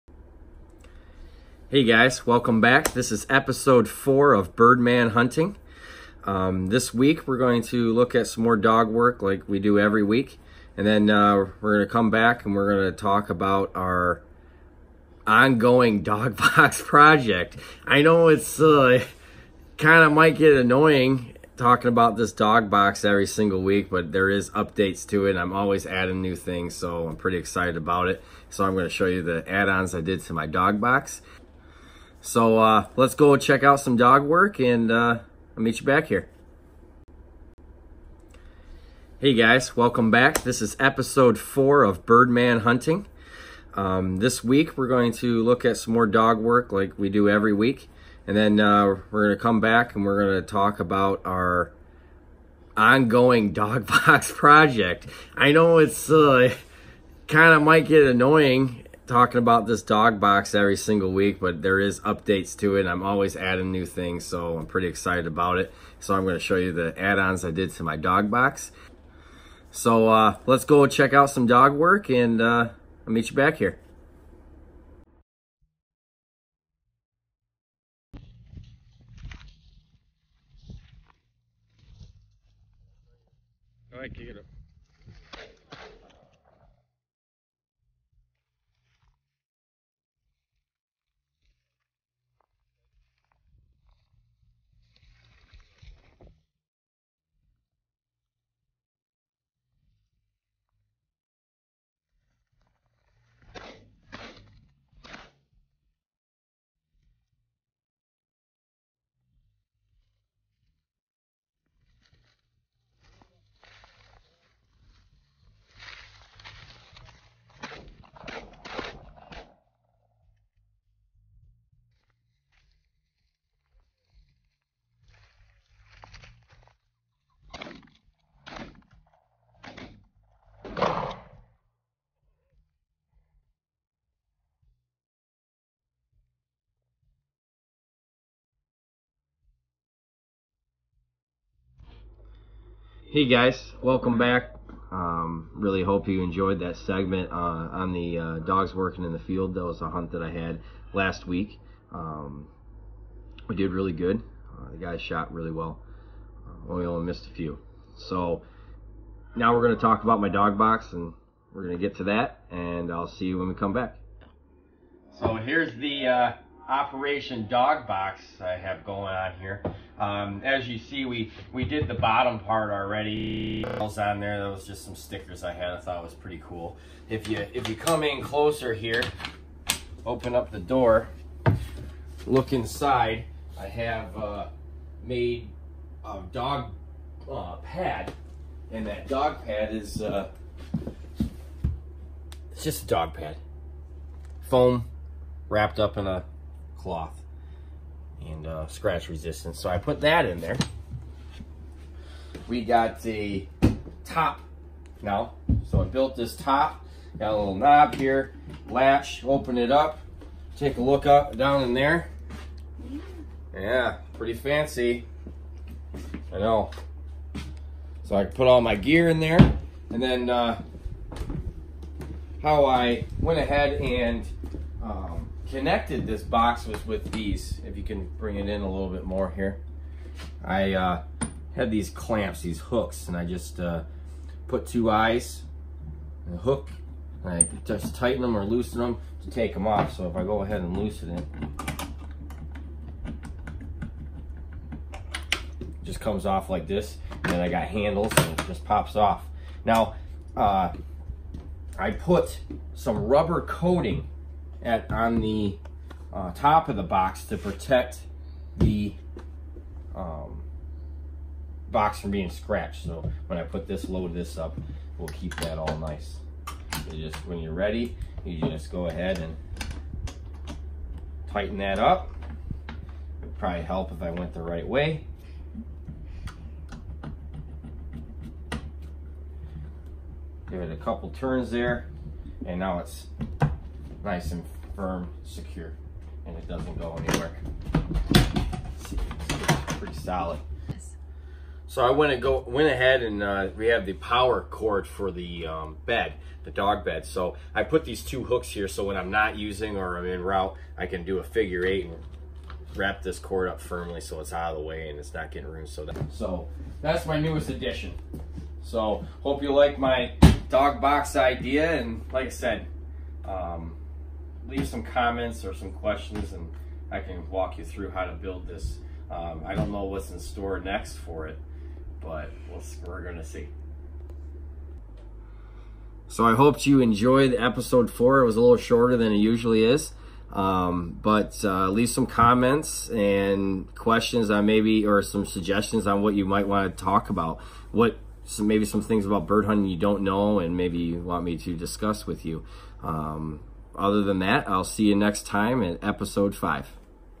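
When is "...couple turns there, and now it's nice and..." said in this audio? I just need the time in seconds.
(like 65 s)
280 s.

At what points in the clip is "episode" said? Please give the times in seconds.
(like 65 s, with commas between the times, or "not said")
3 s, 40 s, 327 s, 345 s.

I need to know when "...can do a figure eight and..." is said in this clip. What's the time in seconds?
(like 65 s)
300 s.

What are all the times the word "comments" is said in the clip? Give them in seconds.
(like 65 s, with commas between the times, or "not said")
314 s, 332 s.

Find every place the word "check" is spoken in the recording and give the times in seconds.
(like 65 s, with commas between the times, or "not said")
33 s, 70 s.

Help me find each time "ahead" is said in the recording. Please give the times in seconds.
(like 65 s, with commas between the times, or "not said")
223 s, 240 s, 268 s, 292 s.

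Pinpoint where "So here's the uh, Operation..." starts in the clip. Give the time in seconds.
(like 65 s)
165 s.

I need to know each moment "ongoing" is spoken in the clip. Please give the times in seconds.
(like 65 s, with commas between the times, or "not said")
15 s, 52 s.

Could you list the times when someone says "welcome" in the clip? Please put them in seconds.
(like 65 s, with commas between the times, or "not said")
2 s, 39 s, 143 s.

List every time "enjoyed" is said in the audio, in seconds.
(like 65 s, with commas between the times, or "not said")
146 s, 326 s.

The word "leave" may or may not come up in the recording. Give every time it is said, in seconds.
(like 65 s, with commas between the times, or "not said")
314 s, 331 s.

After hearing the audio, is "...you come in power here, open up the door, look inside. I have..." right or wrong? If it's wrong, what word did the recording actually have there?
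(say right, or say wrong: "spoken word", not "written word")
wrong: "closer", not "power".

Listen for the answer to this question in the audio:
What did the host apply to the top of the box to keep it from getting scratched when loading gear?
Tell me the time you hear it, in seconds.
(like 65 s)
253 s.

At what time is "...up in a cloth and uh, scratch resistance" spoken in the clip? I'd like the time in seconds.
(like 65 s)
195 s.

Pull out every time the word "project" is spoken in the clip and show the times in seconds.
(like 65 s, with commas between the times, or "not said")
16 s, 54 s.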